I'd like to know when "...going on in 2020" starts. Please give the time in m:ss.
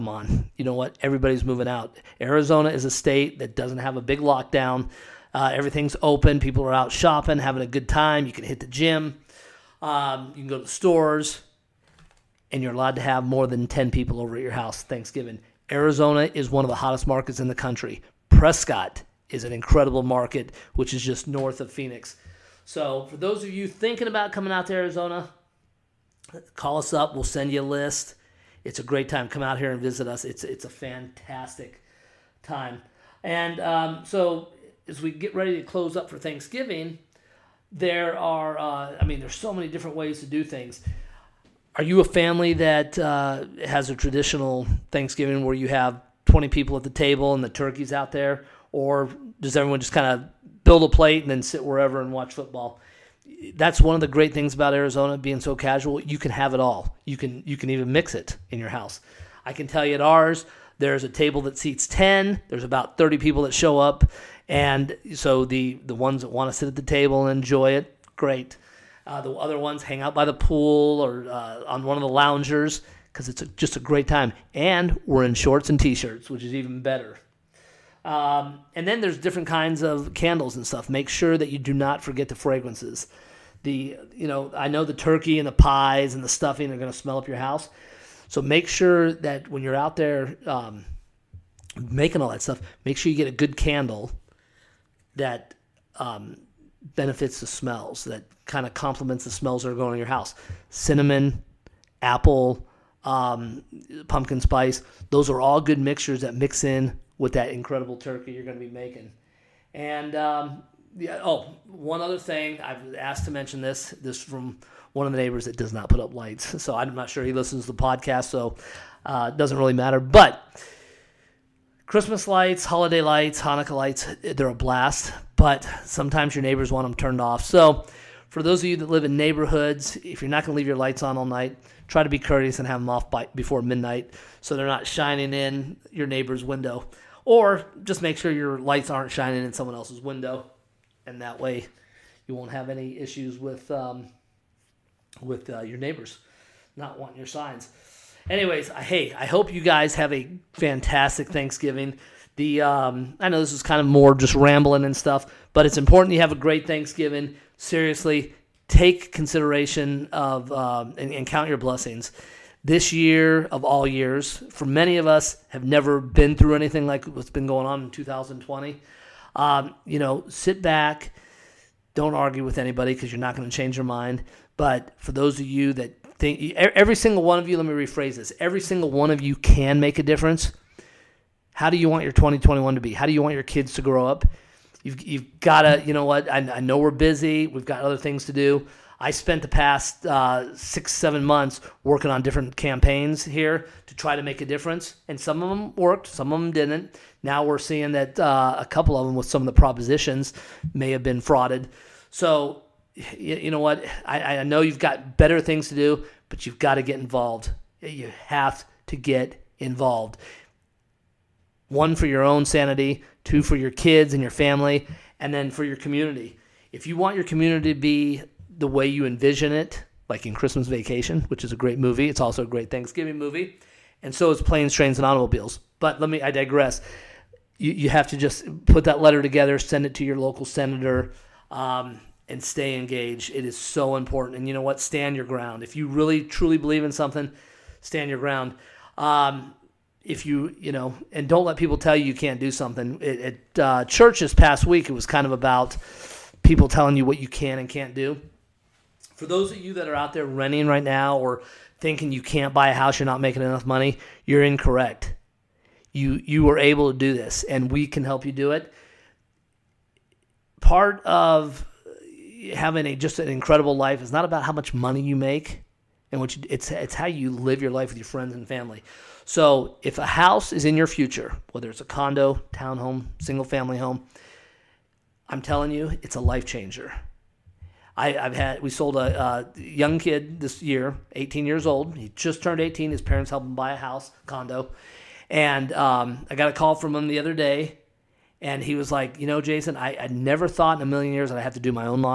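2:47.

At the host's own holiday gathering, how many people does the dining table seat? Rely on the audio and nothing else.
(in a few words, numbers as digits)
10.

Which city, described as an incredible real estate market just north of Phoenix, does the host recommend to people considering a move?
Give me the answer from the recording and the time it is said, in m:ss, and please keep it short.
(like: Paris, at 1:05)
Prescott, at 0:18.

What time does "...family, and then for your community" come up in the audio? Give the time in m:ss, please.
3:34.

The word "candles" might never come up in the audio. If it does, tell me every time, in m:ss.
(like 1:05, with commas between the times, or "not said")
1:20, 1:33.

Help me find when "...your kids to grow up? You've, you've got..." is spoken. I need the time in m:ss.
3:03.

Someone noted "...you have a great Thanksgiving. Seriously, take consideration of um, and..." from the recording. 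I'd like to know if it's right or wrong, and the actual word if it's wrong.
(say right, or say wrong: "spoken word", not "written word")
right.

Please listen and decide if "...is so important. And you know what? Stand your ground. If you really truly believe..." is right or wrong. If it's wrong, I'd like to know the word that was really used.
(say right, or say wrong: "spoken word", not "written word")
right.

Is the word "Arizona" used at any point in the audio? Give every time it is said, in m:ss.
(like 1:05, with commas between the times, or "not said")
0:02, 0:15, 0:24, 0:54.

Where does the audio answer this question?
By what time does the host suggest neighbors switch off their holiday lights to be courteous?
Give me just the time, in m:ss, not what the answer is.
2:13.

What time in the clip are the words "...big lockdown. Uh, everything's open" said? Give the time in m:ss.
0:04.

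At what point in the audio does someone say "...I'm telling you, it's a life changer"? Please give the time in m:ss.
4:35.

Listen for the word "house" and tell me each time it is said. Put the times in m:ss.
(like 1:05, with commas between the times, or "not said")
0:14, 0:58, 1:27, 1:40, 4:12, 4:30, 4:43.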